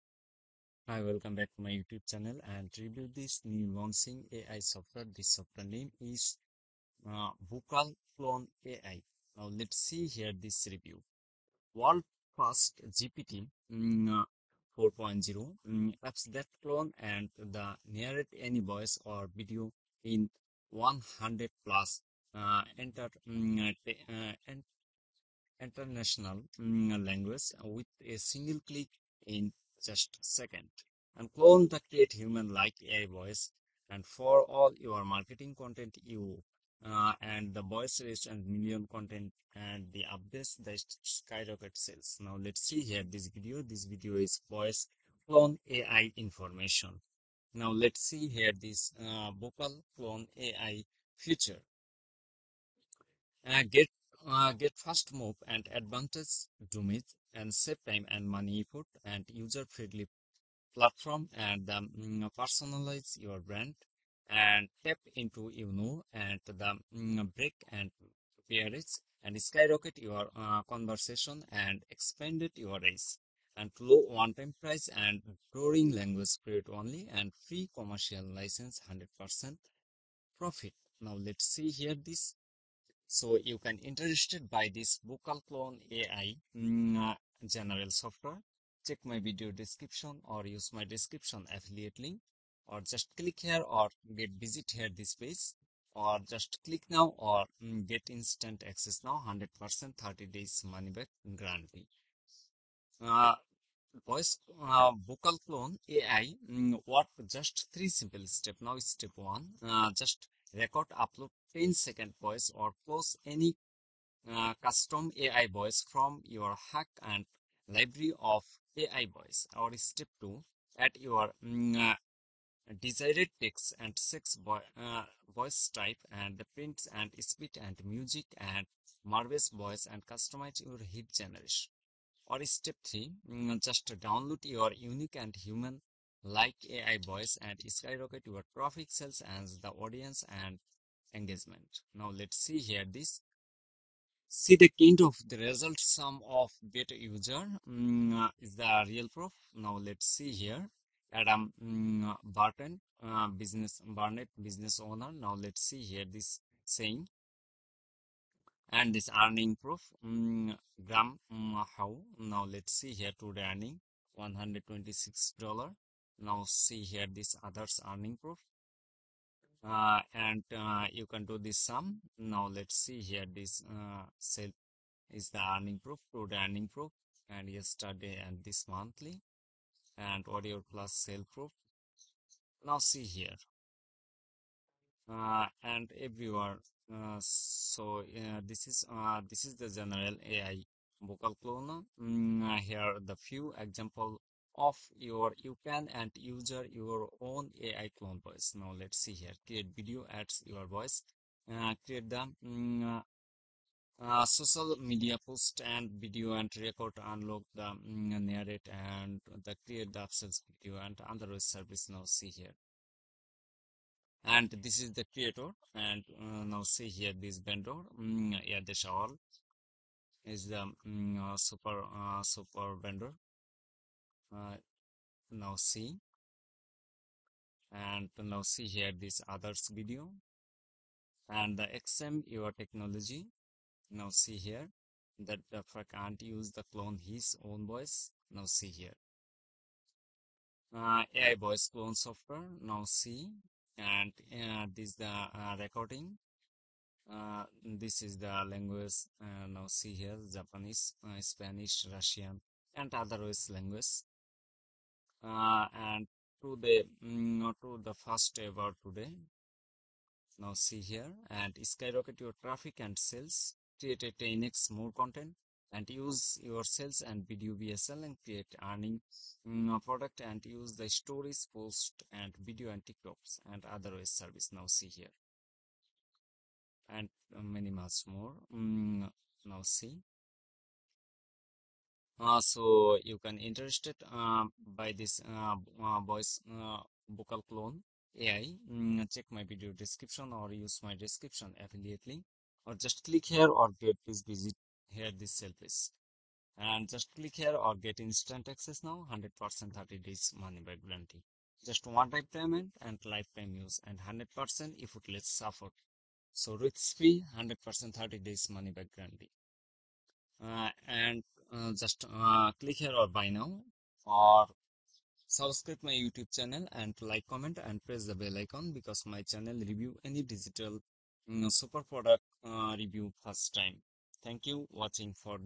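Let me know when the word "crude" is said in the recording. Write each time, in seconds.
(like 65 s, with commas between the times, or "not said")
176 s.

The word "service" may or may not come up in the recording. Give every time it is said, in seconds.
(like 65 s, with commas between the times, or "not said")
211 s, 274 s, 295 s.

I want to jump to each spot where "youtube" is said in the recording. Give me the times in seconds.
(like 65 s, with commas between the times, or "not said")
1 s, 315 s.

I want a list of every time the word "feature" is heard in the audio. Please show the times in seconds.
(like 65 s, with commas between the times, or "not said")
51 s.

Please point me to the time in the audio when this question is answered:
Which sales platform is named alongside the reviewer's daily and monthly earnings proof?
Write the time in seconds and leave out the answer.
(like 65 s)
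180 s.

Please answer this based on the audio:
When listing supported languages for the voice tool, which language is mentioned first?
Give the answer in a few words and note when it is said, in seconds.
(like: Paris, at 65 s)
Japanese, at 250 s.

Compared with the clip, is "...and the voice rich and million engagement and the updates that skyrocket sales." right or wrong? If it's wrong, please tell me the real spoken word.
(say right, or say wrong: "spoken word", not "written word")
wrong: "content", not "engagement".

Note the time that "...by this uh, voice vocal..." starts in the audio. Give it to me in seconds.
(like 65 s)
284 s.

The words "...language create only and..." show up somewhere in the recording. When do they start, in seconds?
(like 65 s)
75 s.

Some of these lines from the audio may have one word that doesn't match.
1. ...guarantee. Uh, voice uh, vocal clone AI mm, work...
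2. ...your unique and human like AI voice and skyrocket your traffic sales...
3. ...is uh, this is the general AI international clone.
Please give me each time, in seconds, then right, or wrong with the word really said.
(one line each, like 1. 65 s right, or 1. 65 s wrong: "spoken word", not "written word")
1. 101 s right
2. 134 s right
3. 188 s wrong: "vocal", not "international".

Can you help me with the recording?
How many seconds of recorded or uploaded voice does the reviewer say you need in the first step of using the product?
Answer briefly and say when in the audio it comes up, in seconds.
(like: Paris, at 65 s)
10 seconds, at 111 s.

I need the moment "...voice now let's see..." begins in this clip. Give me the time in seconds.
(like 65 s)
198 s.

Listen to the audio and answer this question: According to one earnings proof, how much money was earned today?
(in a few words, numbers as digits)
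$126.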